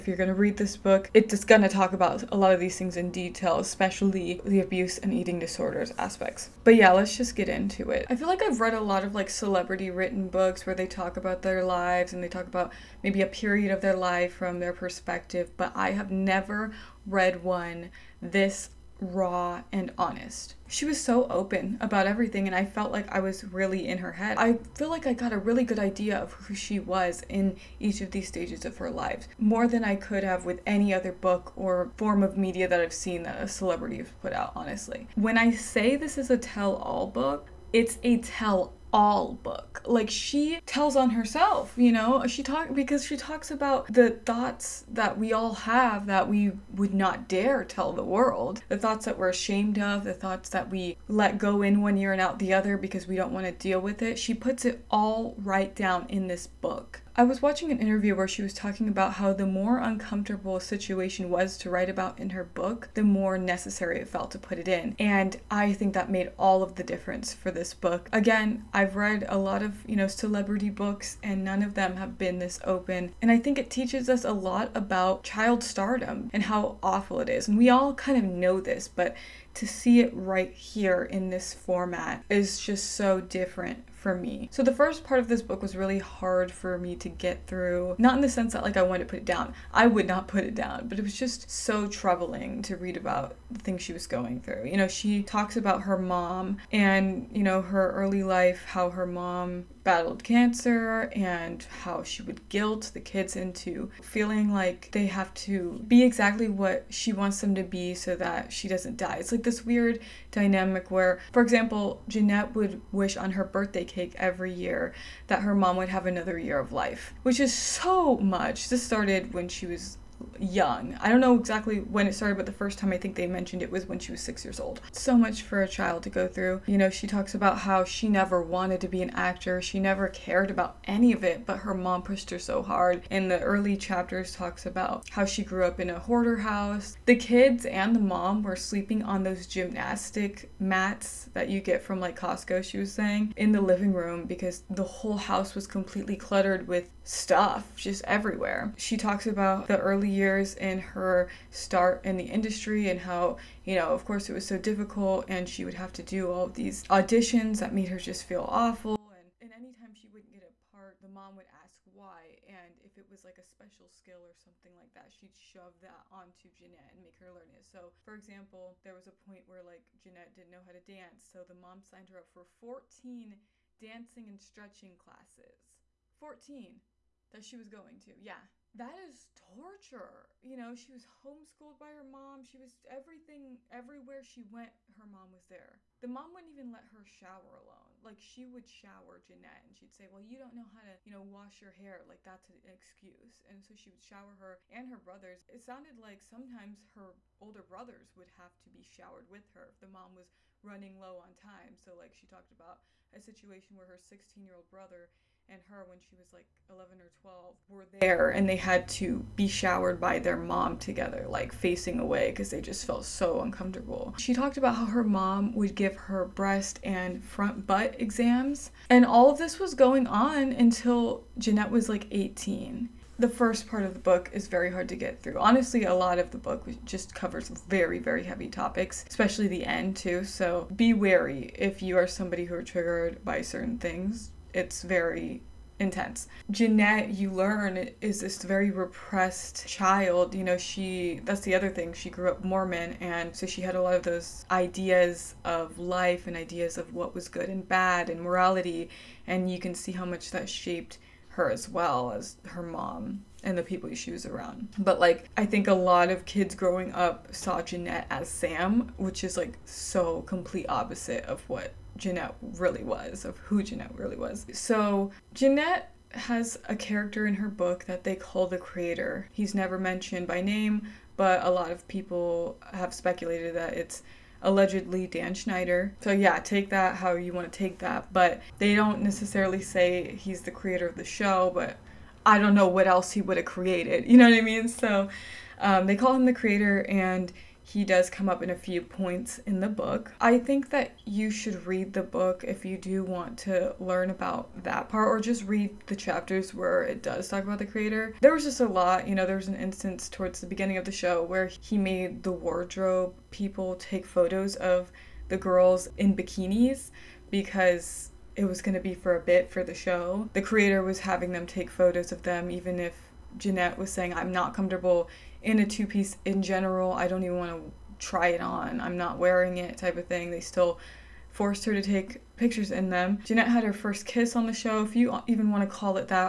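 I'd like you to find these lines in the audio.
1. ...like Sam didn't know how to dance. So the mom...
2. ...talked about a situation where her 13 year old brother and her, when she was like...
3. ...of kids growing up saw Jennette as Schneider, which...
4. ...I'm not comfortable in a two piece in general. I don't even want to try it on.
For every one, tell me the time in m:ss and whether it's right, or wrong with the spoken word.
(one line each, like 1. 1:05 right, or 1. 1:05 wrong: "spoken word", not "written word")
1. 2:49 wrong: "Jennette", not "Sam"
2. 3:22 wrong: "16", not "13"
3. 4:16 wrong: "Sam", not "Schneider"
4. 5:14 right.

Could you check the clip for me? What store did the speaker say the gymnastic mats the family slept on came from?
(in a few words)
Costco.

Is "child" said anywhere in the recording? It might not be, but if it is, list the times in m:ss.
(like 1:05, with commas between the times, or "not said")
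1:15, 2:05, 3:59.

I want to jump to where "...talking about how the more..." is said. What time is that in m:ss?
0:58.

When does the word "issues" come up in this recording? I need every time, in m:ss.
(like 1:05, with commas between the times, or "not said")
not said.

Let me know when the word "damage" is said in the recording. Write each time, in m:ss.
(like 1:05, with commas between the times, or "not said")
not said.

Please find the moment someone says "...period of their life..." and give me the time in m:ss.
0:13.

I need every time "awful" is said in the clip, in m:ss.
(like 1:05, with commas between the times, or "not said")
1:16, 2:38.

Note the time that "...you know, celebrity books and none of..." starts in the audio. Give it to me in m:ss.
1:09.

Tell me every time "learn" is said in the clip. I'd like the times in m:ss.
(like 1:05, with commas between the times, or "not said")
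2:47, 3:57, 4:53.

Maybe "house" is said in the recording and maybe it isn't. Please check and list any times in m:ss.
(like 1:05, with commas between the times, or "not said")
2:16, 2:25.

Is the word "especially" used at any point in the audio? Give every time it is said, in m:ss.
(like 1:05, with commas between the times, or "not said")
0:03, 3:49.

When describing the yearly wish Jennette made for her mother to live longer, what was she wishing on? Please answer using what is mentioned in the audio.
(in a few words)
birthday cake.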